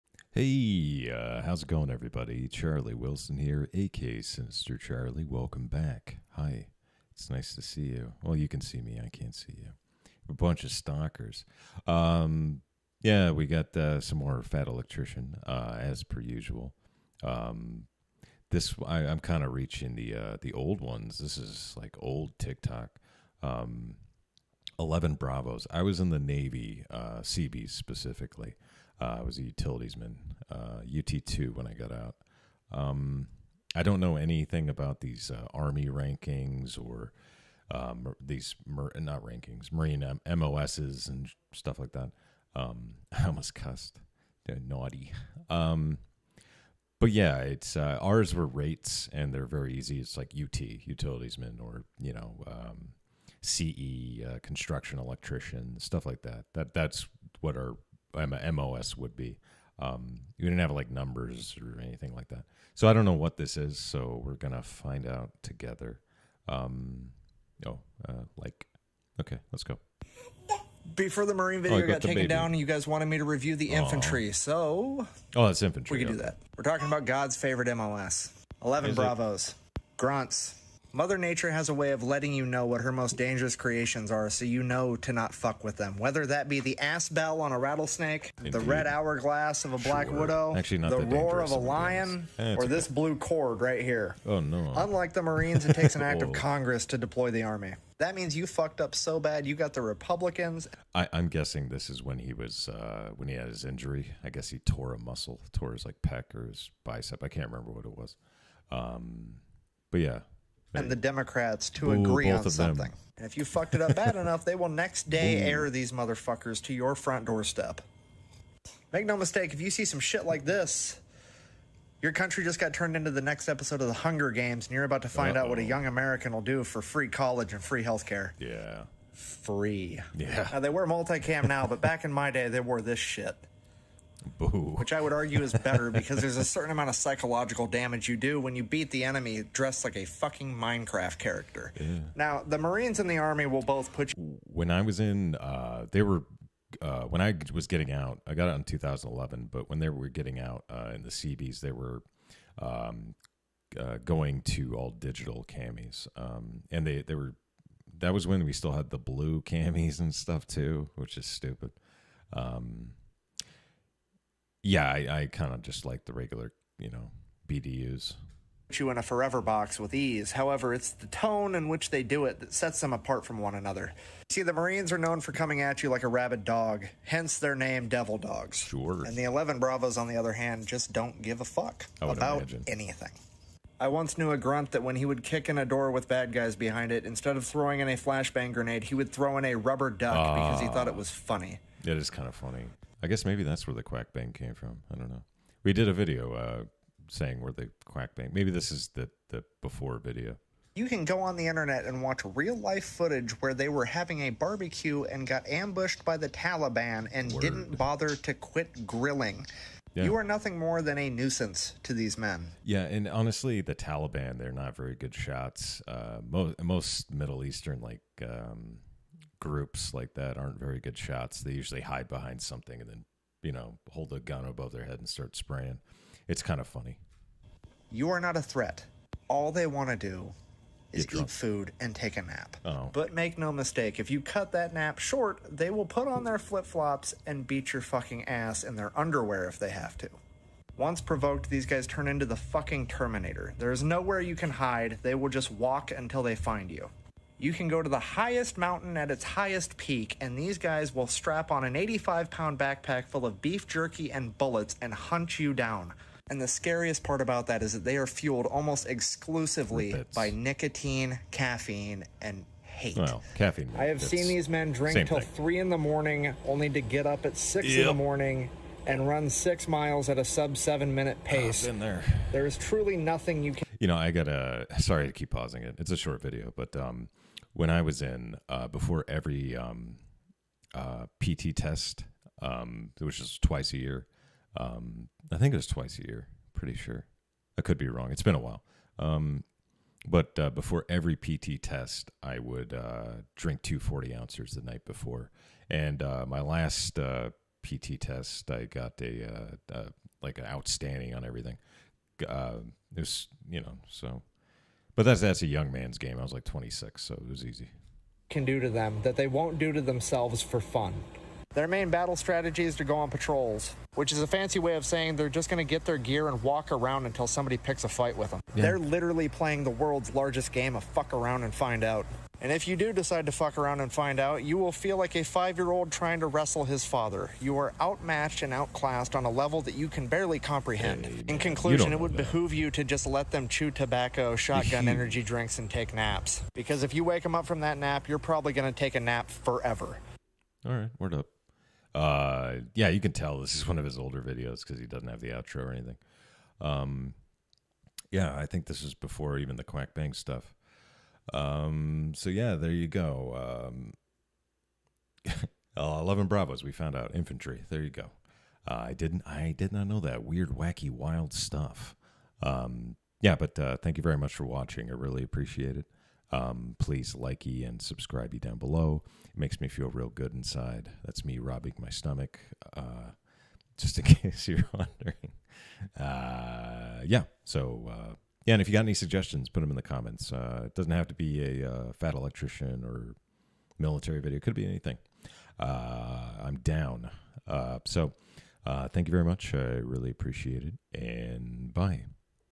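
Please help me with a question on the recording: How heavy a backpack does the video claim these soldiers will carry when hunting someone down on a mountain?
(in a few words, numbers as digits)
85 pounds.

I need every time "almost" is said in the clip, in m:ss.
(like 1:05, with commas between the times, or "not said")
0:43, 4:18.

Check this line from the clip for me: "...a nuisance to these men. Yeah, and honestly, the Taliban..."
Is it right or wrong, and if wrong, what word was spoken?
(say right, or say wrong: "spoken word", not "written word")
right.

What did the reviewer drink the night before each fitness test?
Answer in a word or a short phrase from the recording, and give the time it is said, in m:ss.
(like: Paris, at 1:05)
Two 40 ounces, at 4:53.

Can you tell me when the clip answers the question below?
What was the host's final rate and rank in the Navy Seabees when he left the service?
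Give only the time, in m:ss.
0:30.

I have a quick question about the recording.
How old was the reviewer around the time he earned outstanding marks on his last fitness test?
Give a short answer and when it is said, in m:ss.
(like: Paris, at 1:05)
26, at 5:06.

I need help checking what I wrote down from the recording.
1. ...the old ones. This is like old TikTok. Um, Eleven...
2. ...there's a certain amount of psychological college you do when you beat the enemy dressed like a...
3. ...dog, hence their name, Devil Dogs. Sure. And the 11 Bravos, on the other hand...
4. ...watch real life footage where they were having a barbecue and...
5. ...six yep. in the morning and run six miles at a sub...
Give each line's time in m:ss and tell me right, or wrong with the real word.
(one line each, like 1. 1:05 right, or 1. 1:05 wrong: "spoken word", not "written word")
1. 0:20 right
2. 2:16 wrong: "damage", not "college"
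3. 2:56 right
4. 3:22 right
5. 4:27 right.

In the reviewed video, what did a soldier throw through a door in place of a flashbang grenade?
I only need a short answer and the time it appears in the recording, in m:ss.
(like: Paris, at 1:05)
A rubber duck, at 3:09.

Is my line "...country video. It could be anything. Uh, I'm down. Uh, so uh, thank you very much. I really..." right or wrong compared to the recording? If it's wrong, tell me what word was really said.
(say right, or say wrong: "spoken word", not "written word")
wrong: "military", not "country".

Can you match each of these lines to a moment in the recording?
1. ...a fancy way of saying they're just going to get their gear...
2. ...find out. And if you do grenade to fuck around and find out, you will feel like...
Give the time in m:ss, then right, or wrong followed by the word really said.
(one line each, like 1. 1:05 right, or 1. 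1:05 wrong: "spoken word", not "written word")
1. 5:14 right
2. 5:21 wrong: "decide", not "grenade".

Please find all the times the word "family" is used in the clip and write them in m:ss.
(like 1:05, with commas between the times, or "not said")
not said.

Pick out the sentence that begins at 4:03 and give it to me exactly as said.
There is nowhere you can hide, they will just walk until they find you.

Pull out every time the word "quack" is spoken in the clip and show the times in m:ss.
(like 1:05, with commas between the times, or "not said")
3:13, 3:17, 5:49.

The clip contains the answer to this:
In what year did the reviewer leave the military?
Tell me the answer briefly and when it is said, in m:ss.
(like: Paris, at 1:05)
2011, at 2:28.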